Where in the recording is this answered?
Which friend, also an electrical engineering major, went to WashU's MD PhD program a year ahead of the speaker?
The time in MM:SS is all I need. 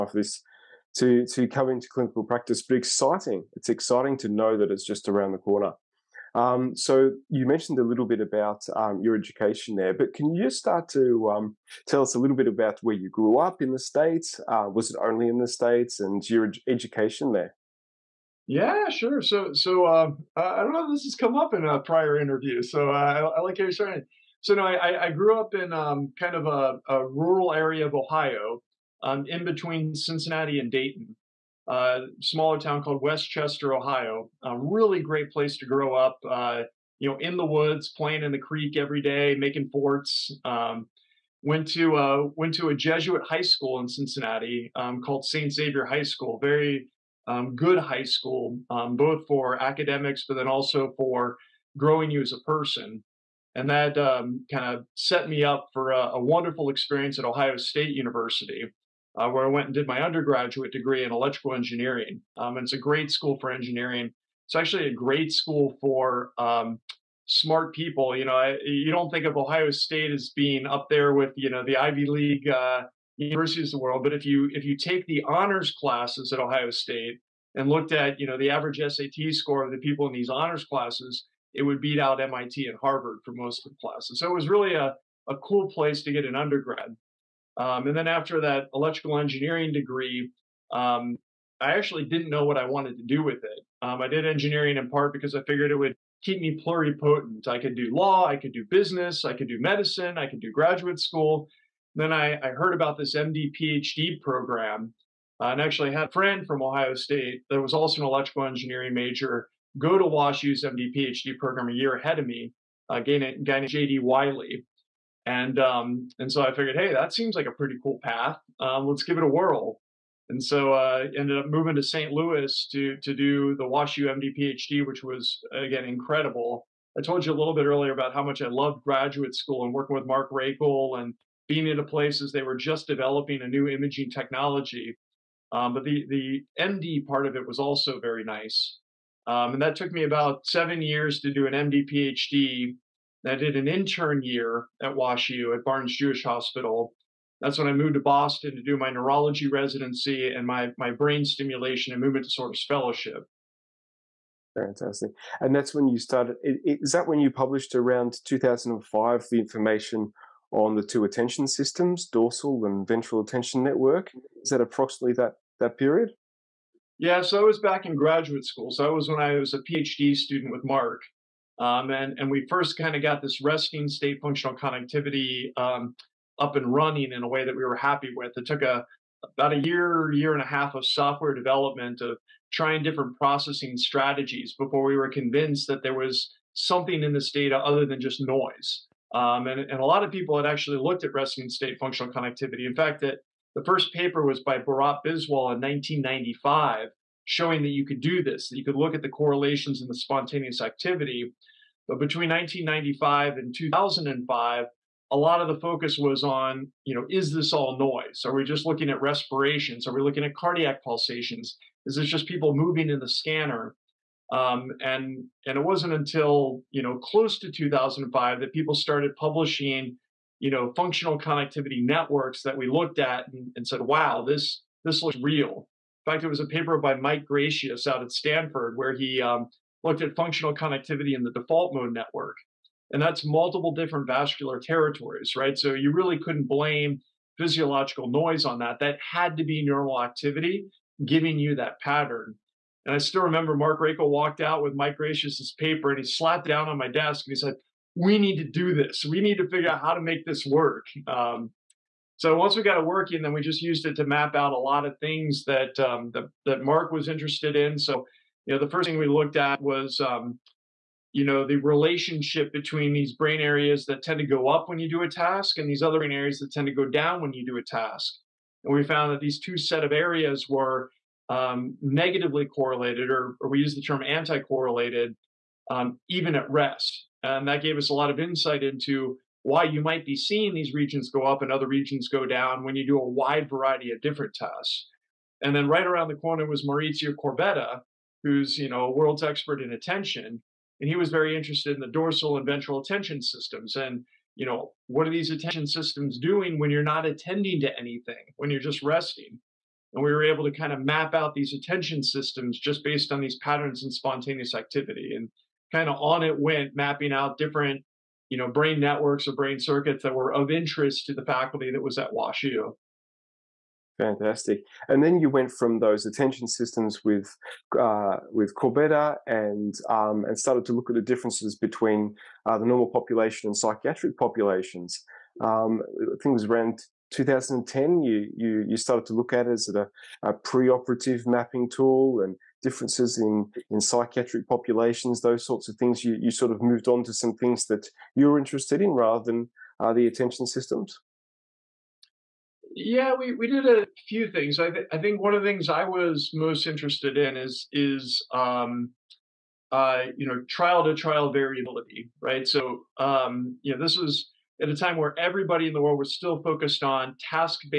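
01:53.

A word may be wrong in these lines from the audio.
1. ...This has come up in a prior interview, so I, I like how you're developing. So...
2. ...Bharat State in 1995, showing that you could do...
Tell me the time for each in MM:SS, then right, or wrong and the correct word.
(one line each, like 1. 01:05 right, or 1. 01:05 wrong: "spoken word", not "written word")
1. 00:20 wrong: "starting", not "developing"
2. 03:14 wrong: "Biswal", not "State".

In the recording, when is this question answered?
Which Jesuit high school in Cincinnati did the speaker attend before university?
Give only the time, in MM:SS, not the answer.
00:45.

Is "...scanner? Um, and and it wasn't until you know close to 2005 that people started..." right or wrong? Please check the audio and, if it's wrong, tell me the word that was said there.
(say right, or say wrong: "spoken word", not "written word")
right.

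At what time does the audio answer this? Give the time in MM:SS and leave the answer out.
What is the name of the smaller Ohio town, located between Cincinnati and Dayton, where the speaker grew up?
00:33.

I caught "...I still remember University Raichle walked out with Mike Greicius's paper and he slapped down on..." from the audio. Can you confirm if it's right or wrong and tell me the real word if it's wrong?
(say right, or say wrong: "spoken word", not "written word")
wrong: "Mark", not "University".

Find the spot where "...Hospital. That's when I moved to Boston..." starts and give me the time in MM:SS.
02:26.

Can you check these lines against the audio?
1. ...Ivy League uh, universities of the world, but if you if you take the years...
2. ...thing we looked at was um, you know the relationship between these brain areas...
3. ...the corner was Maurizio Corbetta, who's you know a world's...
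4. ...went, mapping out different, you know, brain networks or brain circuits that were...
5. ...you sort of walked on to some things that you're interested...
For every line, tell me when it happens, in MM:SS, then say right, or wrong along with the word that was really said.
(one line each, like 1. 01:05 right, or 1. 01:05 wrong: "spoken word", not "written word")
1. 01:11 wrong: "honors", not "years"
2. 04:18 right
3. 04:46 right
4. 05:06 right
5. 05:36 wrong: "moved", not "walked".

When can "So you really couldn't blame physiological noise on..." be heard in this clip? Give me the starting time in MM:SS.
03:55.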